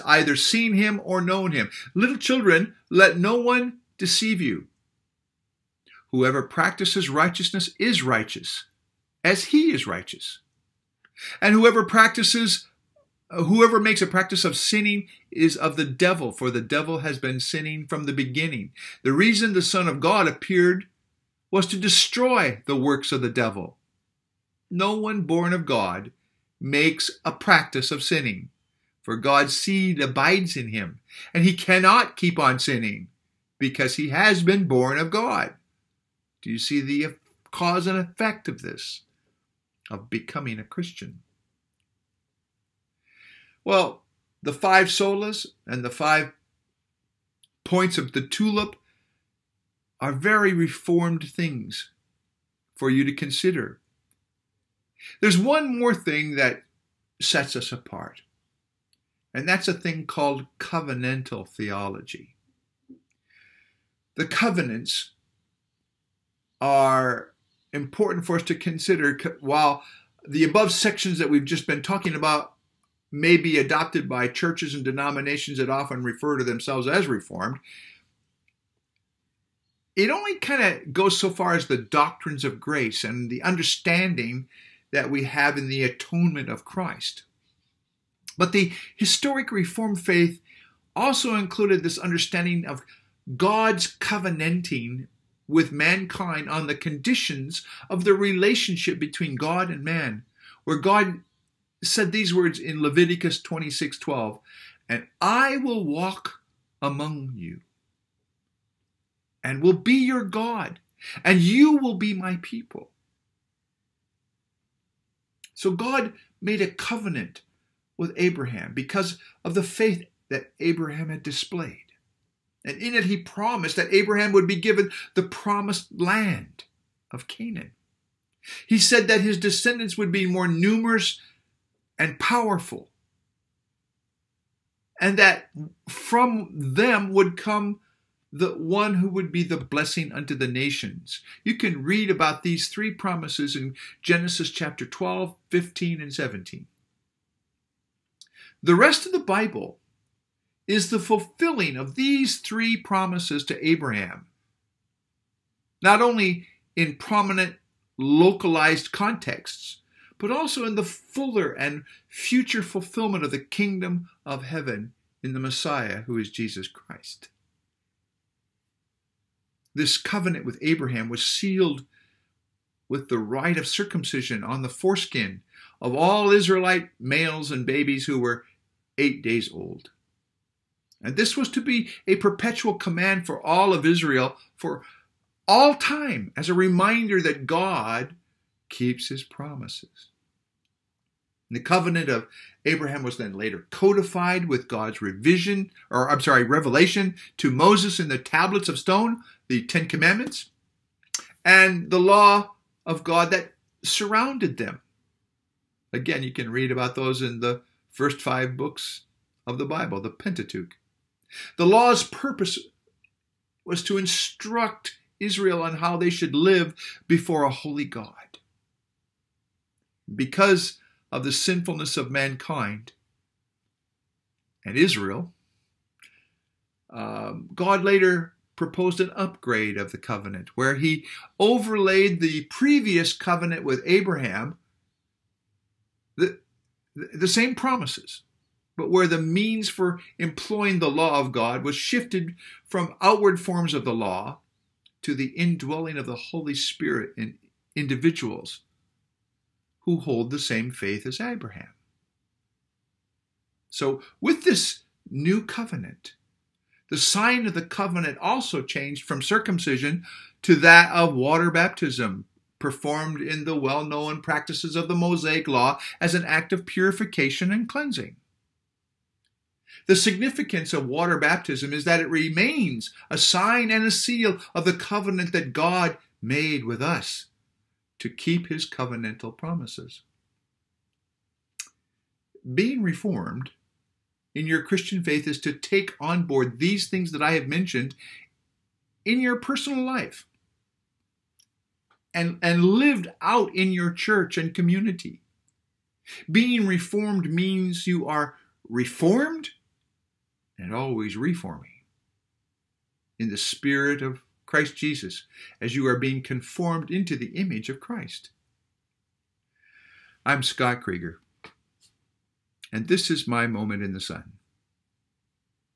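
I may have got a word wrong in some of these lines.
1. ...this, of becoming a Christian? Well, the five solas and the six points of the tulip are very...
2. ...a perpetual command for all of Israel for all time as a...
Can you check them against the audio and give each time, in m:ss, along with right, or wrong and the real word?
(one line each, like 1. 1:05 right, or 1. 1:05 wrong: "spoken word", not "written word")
1. 0:38 wrong: "five", not "six"
2. 3:02 right.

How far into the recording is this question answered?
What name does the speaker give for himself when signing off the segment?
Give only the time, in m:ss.
5:10.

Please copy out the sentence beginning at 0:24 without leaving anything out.
No one born of God makes a practice of sinning.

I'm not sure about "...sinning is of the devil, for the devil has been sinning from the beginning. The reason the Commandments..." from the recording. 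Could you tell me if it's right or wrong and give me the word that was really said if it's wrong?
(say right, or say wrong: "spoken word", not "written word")
wrong: "Son", not "Commandments".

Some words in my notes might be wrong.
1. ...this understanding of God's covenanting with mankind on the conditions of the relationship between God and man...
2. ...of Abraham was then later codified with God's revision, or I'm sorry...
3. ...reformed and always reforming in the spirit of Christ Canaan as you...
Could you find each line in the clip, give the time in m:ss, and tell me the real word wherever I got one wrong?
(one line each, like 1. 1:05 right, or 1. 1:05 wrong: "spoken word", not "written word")
1. 1:31 right
2. 3:12 right
3. 4:58 wrong: "Jesus", not "Canaan".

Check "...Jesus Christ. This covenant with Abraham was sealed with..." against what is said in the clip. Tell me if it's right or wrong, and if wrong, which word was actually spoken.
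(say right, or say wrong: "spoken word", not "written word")
right.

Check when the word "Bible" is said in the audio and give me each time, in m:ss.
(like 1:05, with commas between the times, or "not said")
2:29, 3:29.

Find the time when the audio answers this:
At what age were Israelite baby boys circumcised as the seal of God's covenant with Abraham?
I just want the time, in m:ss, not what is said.
2:58.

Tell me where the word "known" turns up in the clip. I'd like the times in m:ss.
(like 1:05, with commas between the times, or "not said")
0:01, 4:23.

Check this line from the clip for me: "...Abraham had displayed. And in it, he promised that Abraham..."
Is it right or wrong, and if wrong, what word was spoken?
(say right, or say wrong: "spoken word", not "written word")
right.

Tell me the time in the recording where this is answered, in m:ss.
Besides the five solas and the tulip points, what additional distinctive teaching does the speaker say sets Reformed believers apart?
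1:00.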